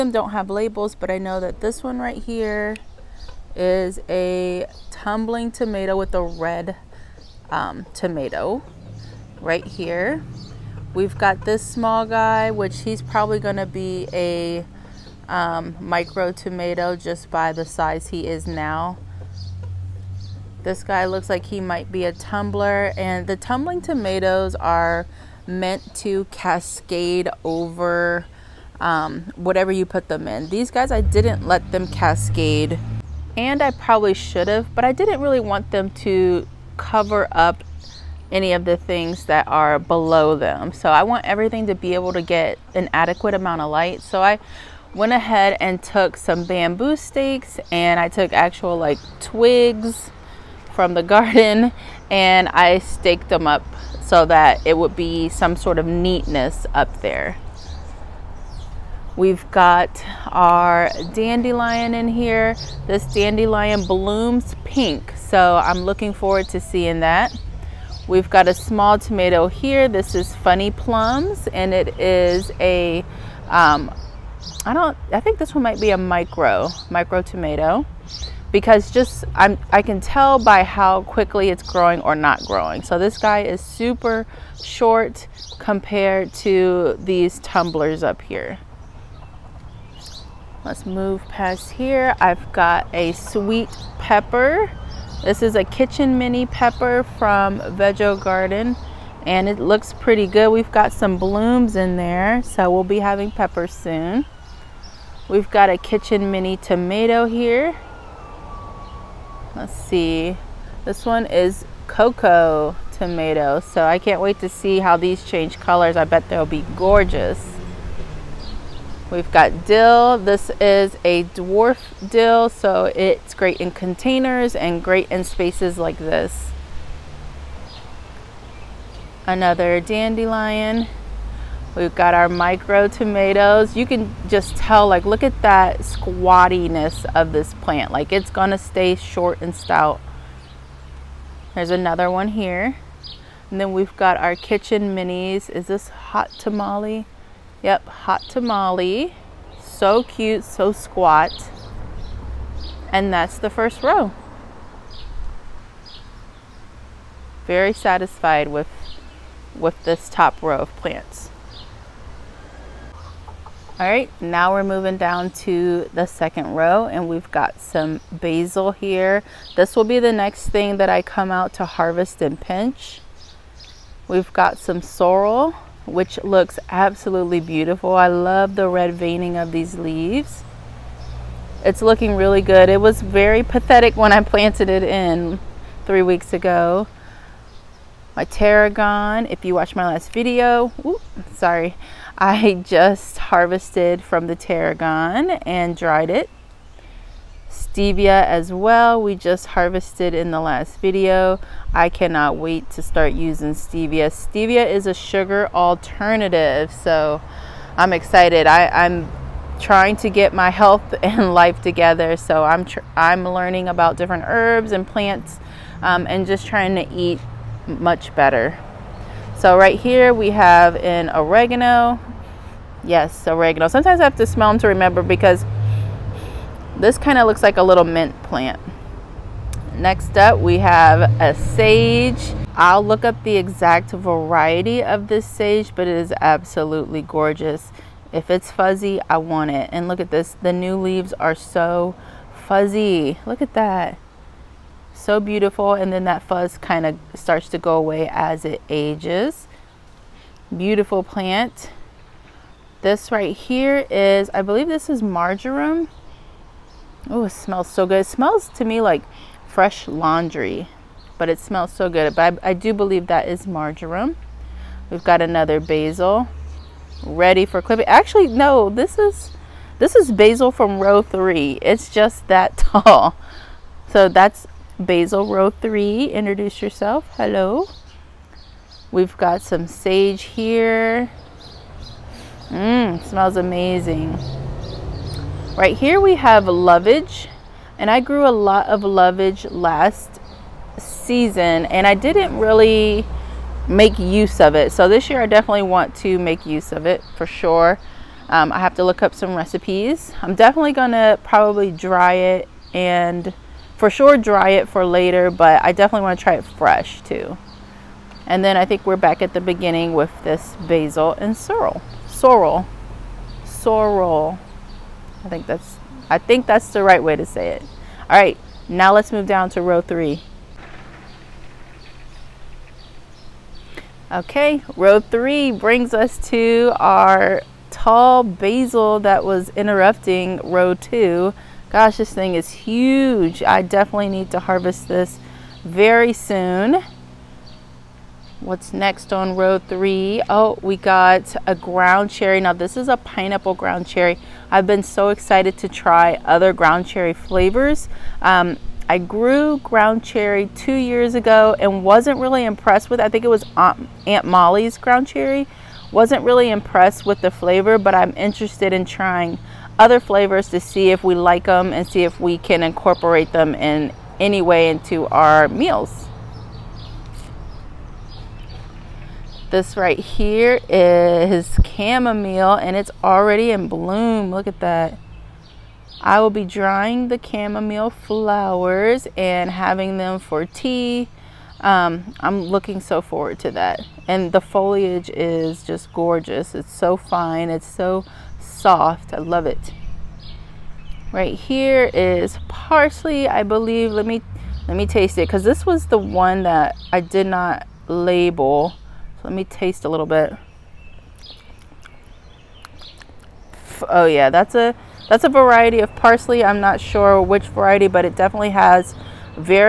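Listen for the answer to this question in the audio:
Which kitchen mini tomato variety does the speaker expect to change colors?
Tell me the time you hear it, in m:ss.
1:51.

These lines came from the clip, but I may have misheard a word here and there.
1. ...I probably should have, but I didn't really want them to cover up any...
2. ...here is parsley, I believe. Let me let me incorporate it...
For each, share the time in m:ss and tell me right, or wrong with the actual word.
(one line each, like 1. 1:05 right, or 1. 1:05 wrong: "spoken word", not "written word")
1. 0:33 right
2. 6:31 wrong: "taste", not "incorporate".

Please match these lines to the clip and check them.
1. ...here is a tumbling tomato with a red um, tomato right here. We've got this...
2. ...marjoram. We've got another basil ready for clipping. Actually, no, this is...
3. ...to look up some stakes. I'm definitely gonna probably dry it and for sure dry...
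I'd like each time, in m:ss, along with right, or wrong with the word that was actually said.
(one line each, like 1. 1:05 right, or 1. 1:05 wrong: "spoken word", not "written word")
1. 0:02 right
2. 4:23 right
3. 4:58 wrong: "recipes", not "stakes".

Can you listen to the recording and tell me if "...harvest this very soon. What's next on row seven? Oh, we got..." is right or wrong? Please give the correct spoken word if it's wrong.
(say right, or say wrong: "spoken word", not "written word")
wrong: "three", not "seven".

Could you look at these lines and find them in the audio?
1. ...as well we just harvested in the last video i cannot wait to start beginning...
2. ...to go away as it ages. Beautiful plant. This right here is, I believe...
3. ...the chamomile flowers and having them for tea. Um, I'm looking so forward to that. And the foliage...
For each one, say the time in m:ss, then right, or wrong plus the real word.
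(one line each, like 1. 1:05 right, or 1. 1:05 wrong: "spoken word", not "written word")
1. 3:18 wrong: "using", not "beginning"
2. 4:07 right
3. 6:17 right.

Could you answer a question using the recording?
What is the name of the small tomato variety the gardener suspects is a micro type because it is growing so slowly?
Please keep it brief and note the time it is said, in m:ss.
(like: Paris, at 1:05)
Funny Plums, at 1:10.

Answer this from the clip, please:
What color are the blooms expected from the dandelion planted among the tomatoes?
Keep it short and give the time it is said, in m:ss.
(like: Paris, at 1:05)
Pink, at 1:04.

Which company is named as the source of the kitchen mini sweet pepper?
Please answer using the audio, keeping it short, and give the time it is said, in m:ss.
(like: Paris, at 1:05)
Veggie Garden, at 1:37.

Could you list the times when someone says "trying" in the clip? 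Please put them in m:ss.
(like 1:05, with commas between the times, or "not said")
3:29, 3:36, 5:58.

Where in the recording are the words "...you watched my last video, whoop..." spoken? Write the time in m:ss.
3:09.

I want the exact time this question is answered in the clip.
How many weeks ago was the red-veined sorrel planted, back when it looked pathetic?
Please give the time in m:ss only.
3:05.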